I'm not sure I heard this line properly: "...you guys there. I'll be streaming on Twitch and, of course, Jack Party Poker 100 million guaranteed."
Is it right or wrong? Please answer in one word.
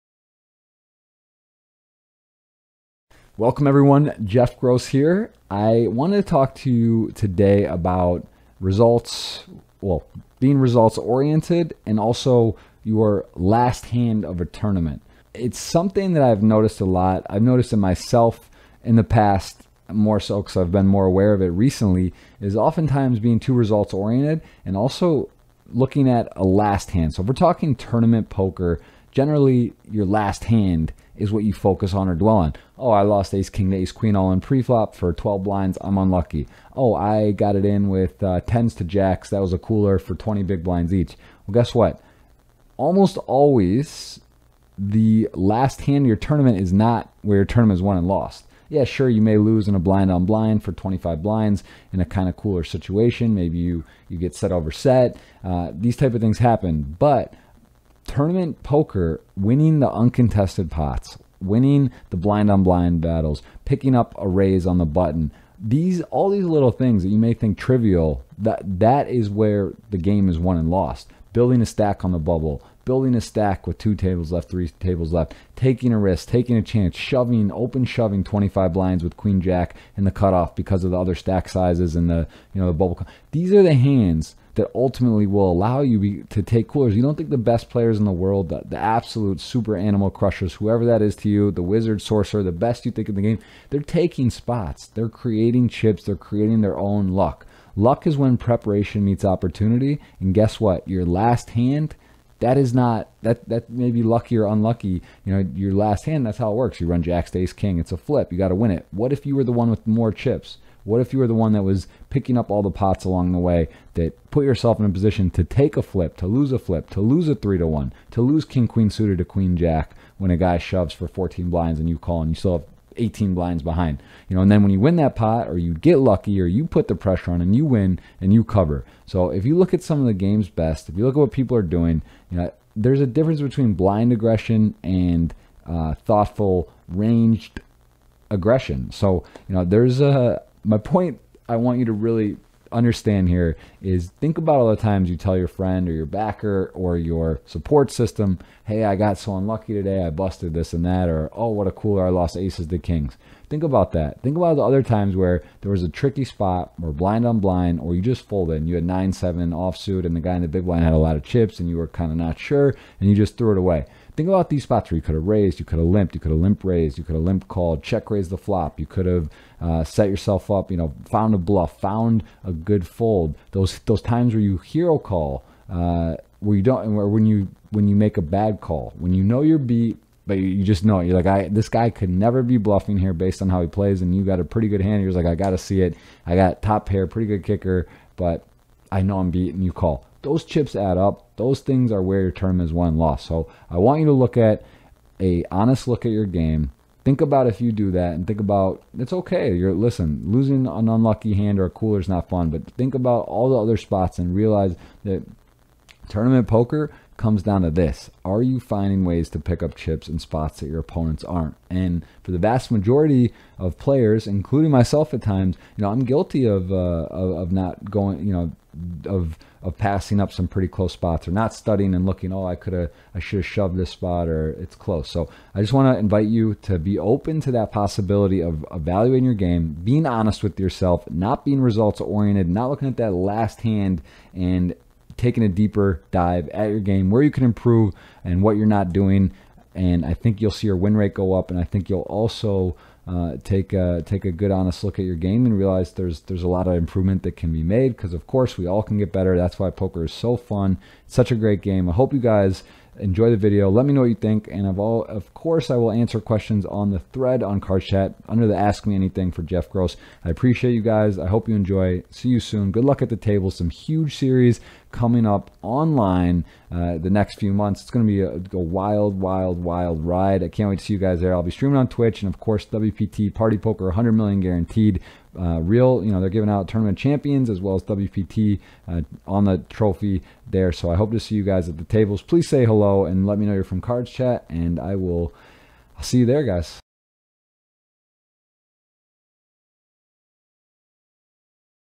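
wrong.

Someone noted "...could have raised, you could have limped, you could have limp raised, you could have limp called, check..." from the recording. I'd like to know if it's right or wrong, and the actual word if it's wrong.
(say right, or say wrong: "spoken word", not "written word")
right.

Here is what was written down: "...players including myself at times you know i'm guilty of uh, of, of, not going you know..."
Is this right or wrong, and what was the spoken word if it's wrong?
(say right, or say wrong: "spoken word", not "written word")
right.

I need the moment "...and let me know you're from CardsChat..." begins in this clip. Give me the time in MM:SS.
04:43.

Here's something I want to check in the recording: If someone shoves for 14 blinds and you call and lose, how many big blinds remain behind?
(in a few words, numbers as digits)
18.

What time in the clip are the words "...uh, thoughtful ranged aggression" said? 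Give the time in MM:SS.
02:15.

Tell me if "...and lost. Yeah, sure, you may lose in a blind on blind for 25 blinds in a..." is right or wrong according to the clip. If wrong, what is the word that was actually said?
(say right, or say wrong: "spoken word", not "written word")
right.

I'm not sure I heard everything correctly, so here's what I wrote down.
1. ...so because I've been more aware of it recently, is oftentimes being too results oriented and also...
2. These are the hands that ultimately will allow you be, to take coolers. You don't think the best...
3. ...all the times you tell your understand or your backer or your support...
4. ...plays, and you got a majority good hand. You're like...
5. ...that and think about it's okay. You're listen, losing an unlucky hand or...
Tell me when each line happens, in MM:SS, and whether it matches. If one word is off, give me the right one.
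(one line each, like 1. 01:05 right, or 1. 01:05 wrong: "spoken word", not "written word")
1. 00:20 right
2. 01:23 right
3. 02:24 wrong: "friend", not "understand"
4. 03:03 wrong: "pretty", not "majority"
5. 03:17 right.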